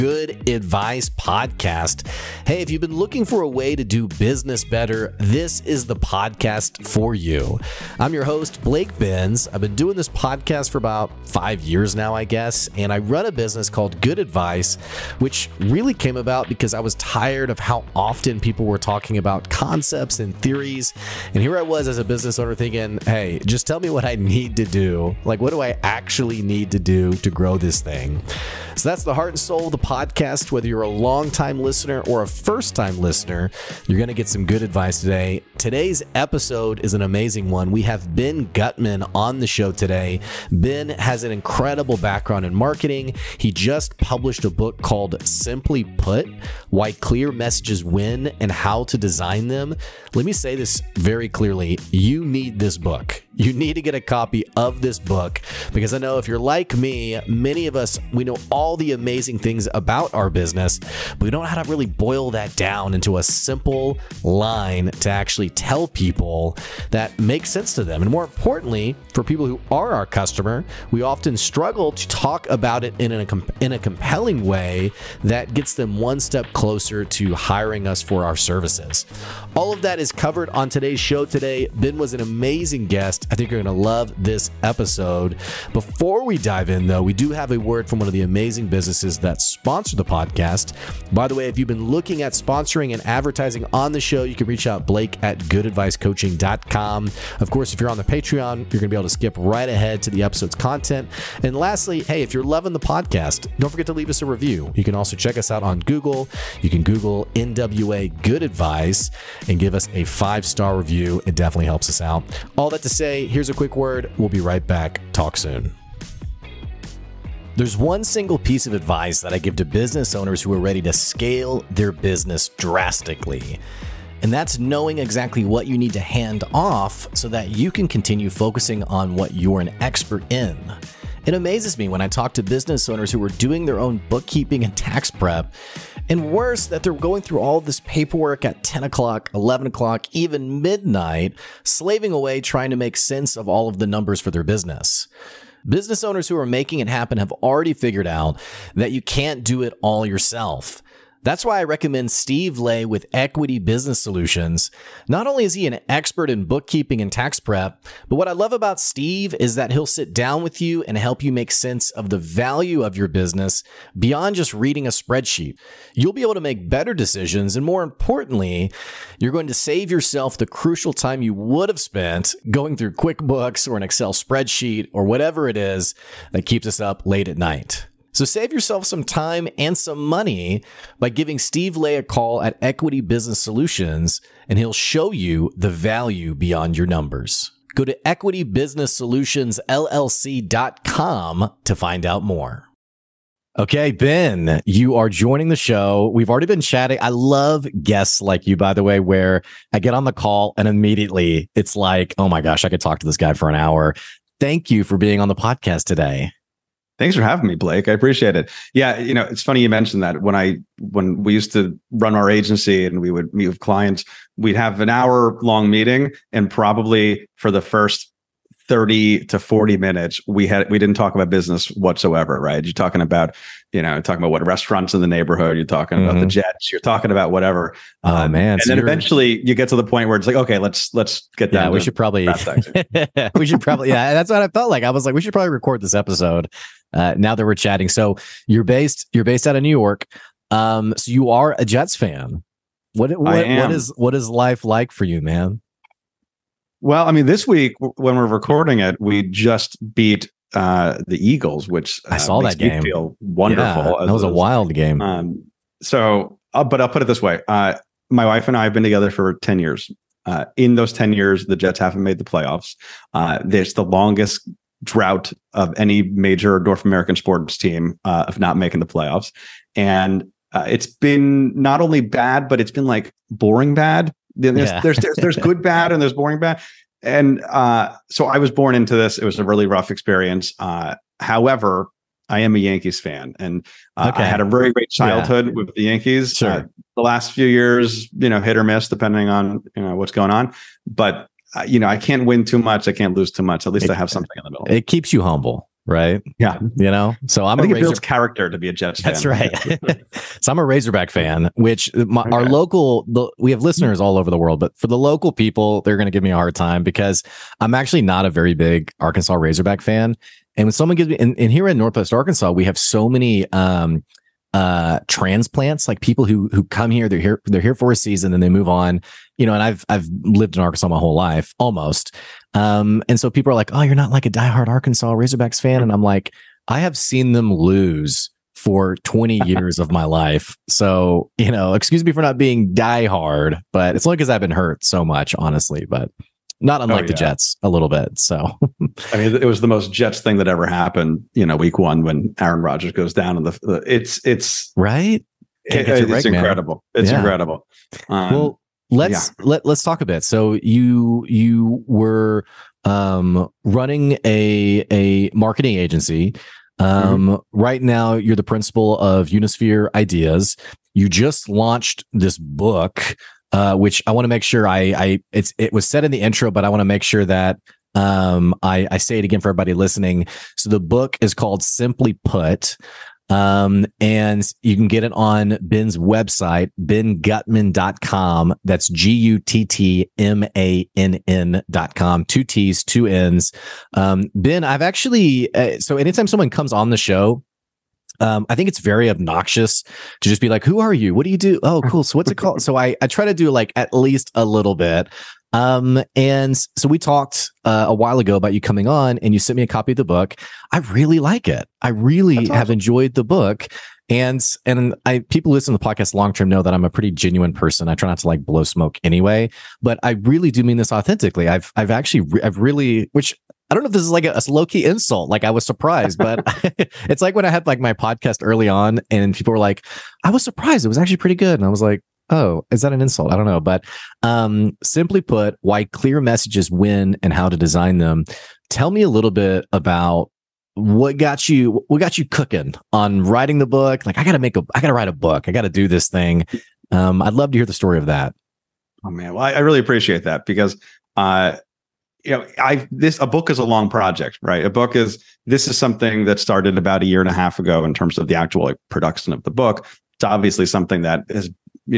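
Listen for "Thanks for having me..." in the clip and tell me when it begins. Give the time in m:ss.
3:26.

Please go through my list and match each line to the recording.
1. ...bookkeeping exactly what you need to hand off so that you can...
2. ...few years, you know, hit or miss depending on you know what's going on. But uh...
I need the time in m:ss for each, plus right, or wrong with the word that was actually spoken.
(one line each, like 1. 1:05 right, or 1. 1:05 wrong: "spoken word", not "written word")
1. 2:04 wrong: "knowing", not "bookkeeping"
2. 4:47 right.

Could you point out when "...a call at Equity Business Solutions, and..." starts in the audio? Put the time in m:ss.
3:01.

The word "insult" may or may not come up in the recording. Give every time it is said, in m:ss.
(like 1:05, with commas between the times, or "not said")
6:54, 7:02.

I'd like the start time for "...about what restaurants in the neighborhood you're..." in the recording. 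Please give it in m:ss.
3:44.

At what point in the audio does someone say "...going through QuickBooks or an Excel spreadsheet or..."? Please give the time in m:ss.
2:52.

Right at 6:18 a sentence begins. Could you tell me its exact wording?
That's G U T T M A N N.com.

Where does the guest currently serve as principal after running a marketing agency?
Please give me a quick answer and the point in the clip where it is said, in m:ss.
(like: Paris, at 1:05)
Unisphere Ideas, at 5:59.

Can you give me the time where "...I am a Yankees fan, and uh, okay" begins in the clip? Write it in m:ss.
4:42.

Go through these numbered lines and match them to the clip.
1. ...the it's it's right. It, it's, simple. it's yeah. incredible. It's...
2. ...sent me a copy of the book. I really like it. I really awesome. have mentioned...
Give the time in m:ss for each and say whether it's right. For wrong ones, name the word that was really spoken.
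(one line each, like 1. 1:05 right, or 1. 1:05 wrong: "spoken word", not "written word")
1. 5:43 wrong: "incredible", not "simple"
2. 6:39 wrong: "enjoyed", not "mentioned".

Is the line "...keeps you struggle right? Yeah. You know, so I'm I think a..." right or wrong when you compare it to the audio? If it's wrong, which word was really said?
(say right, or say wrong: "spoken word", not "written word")
wrong: "humble", not "struggle".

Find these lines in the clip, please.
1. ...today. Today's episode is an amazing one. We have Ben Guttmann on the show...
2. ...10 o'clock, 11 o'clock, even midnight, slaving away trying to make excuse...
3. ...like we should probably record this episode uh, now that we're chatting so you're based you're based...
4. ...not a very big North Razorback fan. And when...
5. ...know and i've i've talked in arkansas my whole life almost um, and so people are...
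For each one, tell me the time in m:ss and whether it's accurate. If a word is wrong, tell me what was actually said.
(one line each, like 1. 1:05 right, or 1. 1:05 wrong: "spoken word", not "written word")
1. 0:34 right
2. 2:18 wrong: "sense", not "excuse"
3. 3:55 right
4. 5:08 wrong: "Arkansas", not "North"
5. 5:19 wrong: "lived", not "talked".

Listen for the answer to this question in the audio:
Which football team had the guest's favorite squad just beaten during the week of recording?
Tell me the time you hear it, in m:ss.
4:11.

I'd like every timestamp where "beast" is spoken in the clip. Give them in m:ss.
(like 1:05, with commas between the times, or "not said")
not said.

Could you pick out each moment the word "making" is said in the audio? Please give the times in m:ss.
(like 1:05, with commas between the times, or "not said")
2:26, 4:28.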